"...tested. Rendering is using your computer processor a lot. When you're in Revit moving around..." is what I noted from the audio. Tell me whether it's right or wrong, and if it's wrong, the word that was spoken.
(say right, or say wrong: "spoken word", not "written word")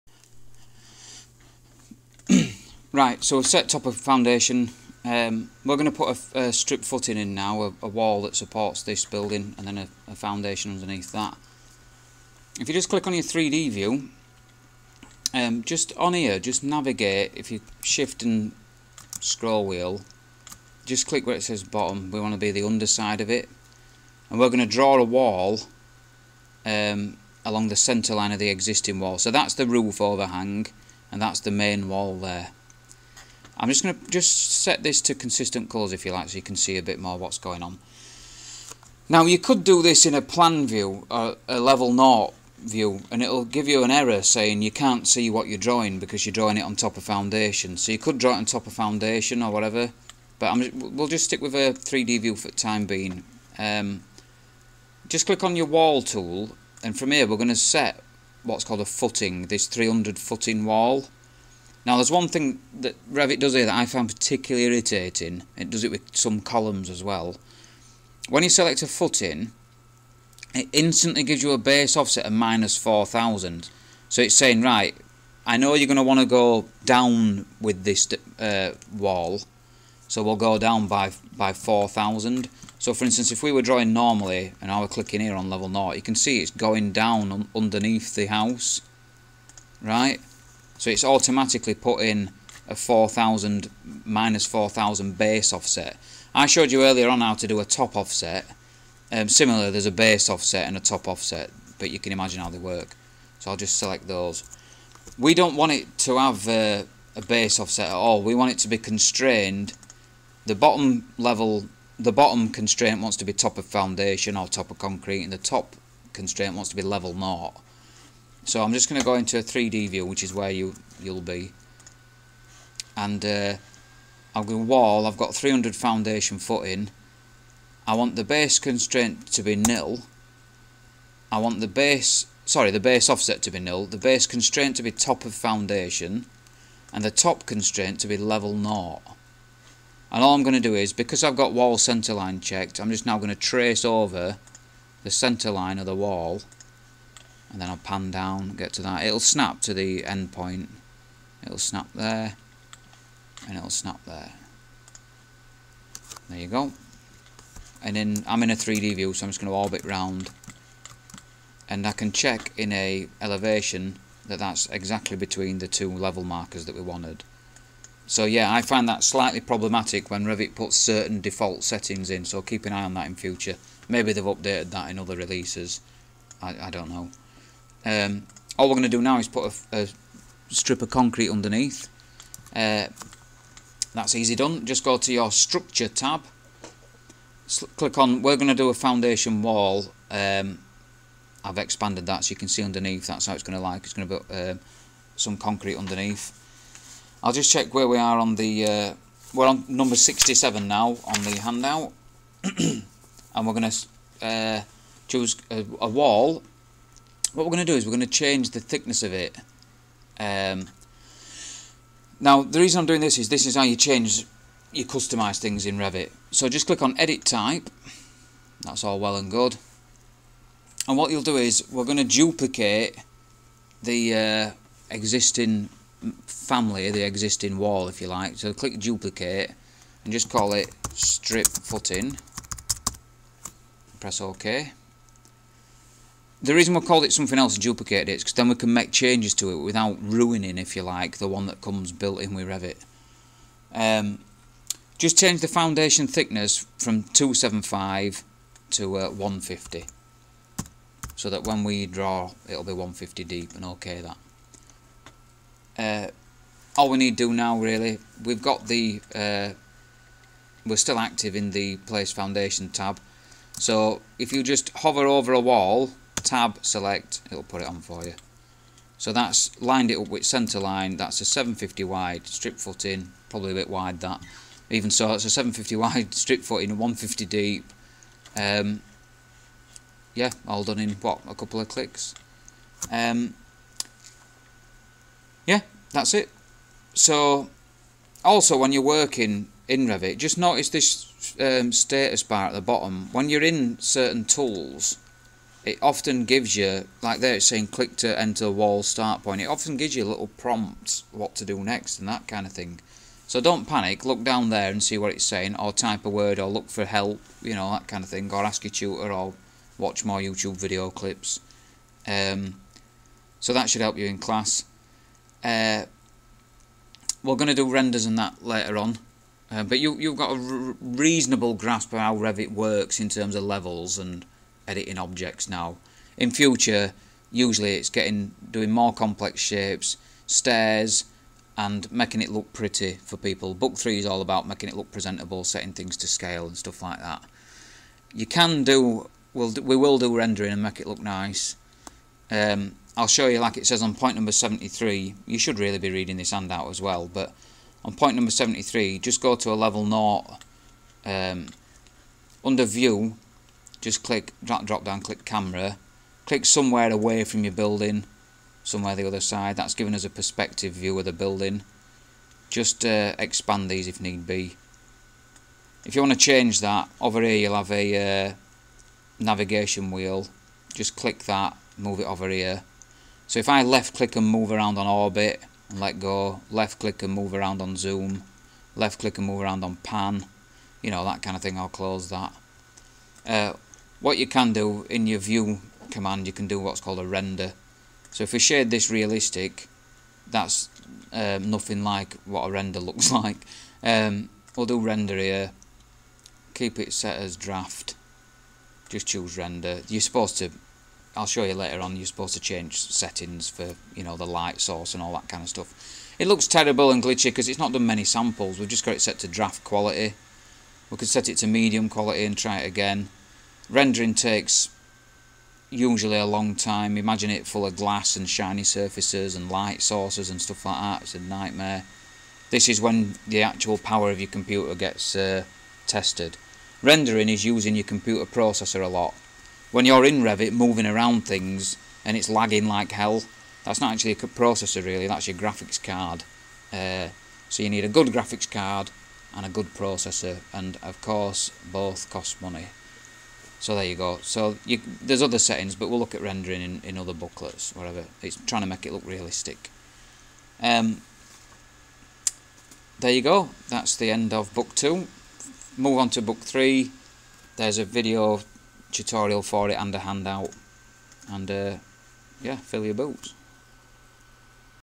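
right.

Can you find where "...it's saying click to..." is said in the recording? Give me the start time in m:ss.
4:57.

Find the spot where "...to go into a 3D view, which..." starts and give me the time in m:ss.
1:58.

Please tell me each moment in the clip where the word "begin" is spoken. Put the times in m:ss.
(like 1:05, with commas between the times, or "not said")
not said.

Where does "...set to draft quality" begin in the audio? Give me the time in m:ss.
6:49.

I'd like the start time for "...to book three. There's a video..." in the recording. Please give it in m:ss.
7:36.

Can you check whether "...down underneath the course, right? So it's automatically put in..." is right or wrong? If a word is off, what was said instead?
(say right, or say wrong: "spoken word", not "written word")
wrong: "house", not "course".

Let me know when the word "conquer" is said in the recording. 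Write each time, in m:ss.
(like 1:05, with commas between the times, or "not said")
not said.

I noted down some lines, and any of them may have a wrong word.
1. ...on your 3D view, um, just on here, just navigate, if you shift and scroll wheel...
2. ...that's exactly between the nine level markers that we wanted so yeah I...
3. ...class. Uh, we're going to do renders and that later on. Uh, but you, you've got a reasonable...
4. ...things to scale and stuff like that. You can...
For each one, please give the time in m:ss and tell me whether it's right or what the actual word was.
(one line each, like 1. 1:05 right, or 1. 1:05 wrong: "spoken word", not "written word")
1. 0:13 right
2. 2:44 wrong: "two", not "nine"
3. 5:14 right
4. 5:35 right.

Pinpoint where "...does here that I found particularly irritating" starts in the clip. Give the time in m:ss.
1:03.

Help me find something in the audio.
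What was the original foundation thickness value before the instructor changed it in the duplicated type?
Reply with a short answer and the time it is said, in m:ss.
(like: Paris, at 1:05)
275, at 4:07.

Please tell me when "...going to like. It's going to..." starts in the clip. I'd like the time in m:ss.
3:13.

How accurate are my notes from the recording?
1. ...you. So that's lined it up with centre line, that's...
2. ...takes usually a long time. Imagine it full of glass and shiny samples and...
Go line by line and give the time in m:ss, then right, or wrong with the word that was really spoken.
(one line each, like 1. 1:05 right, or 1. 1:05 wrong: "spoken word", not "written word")
1. 4:28 right
2. 6:54 wrong: "surfaces", not "samples".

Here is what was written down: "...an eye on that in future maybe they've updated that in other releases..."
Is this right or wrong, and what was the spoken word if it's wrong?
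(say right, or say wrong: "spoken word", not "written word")
right.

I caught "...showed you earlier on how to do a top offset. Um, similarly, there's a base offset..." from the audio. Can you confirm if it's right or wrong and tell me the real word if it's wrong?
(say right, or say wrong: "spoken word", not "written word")
right.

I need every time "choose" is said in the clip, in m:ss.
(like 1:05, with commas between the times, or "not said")
3:25, 6:39.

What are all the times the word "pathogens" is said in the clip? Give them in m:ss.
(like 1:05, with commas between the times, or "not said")
not said.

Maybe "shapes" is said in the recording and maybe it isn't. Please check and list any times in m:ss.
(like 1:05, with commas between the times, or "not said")
5:29.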